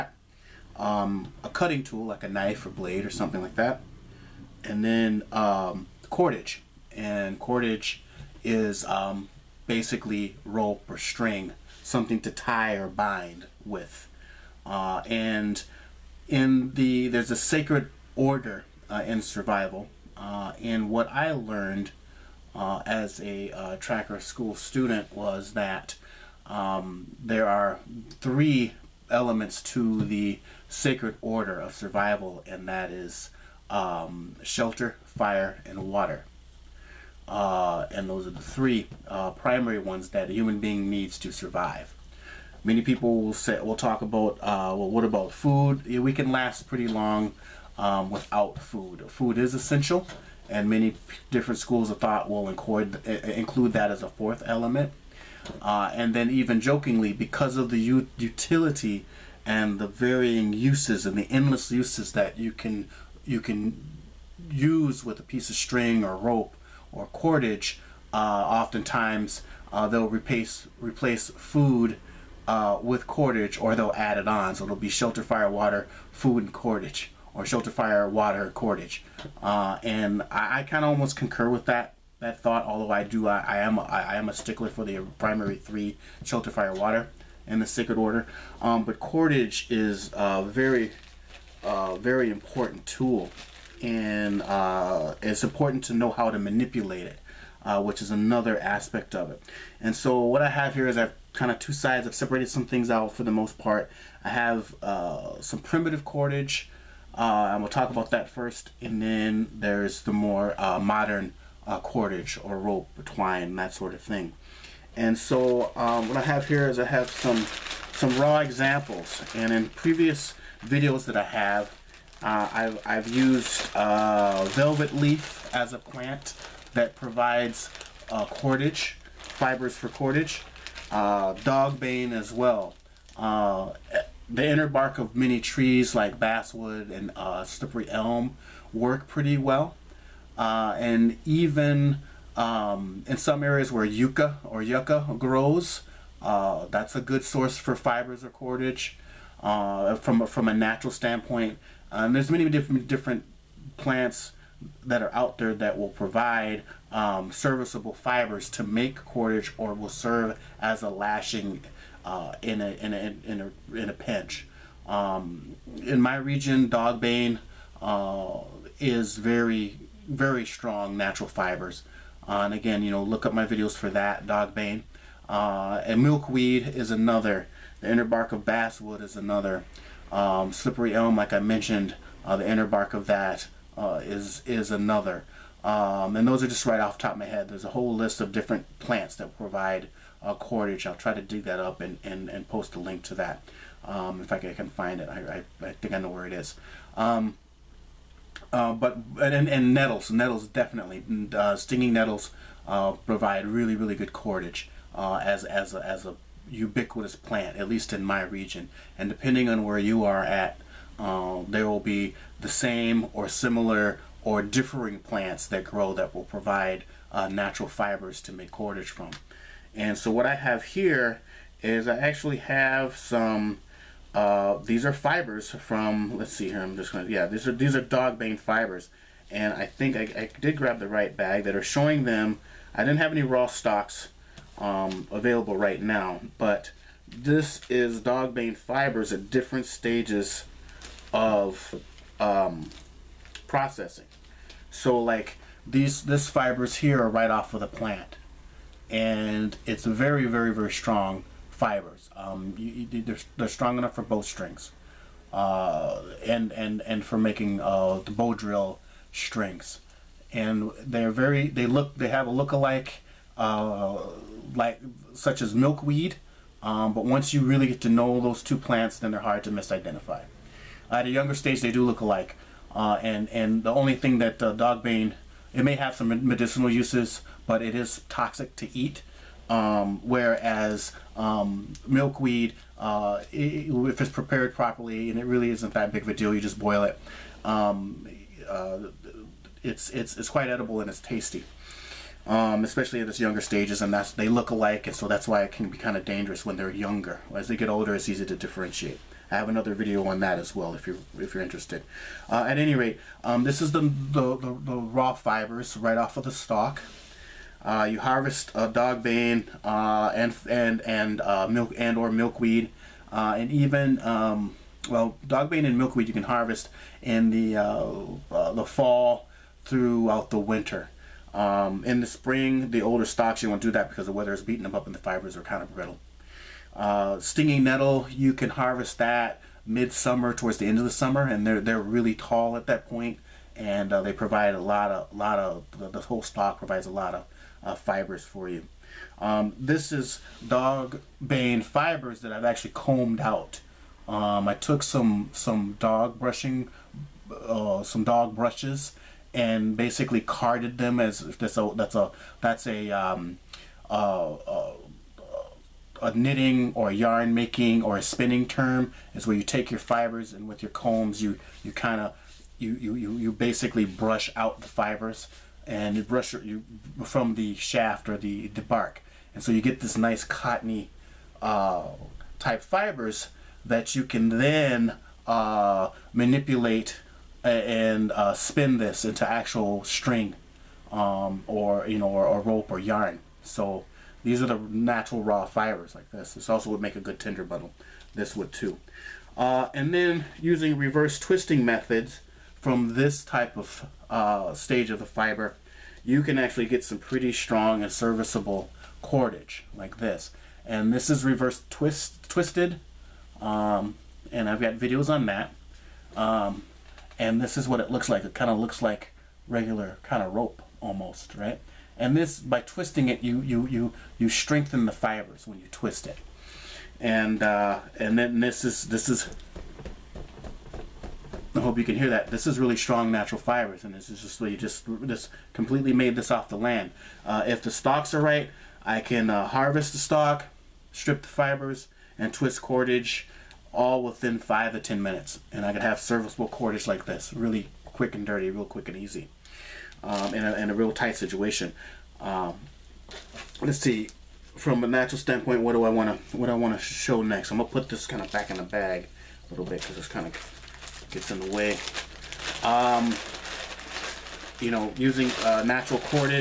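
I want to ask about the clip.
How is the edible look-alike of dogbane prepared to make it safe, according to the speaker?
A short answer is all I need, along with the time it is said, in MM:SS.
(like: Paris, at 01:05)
Boil it, at 04:46.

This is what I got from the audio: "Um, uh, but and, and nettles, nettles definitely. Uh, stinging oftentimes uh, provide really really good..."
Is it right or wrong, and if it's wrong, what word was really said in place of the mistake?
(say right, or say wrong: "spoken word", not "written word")
wrong: "nettles", not "oftentimes".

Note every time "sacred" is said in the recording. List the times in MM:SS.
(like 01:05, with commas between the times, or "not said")
00:17, 00:30, 01:27.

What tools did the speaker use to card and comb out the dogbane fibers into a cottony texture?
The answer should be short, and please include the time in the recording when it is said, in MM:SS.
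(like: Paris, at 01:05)
Dog brushes, at 05:48.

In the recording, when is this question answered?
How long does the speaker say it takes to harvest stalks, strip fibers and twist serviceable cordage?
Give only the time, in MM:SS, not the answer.
07:14.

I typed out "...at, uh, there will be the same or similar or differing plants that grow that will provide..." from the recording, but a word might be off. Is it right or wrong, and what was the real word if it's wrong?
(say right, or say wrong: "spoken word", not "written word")
right.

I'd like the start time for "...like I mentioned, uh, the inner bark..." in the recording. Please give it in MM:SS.
03:01.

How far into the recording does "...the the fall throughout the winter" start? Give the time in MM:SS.
05:17.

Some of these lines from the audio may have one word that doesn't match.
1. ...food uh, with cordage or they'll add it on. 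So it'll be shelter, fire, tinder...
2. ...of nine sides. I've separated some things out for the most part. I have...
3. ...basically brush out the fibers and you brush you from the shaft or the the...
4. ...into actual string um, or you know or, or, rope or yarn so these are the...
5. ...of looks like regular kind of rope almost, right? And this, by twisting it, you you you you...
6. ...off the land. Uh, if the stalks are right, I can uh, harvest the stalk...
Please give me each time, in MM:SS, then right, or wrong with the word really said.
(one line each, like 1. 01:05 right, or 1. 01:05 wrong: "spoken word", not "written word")
1. 01:11 wrong: "water", not "tinder"
2. 01:41 wrong: "two", not "nine"
3. 06:03 right
4. 06:19 right
5. 06:48 right
6. 07:06 right.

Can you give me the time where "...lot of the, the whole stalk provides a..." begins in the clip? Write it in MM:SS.
05:35.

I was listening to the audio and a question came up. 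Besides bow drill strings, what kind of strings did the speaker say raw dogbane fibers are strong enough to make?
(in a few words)
Bow strings.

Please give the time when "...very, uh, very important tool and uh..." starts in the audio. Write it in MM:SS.
01:30.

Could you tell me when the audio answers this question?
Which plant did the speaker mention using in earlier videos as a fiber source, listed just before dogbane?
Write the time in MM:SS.
02:04.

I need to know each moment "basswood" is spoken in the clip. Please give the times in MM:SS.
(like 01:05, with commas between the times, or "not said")
02:16, 02:58.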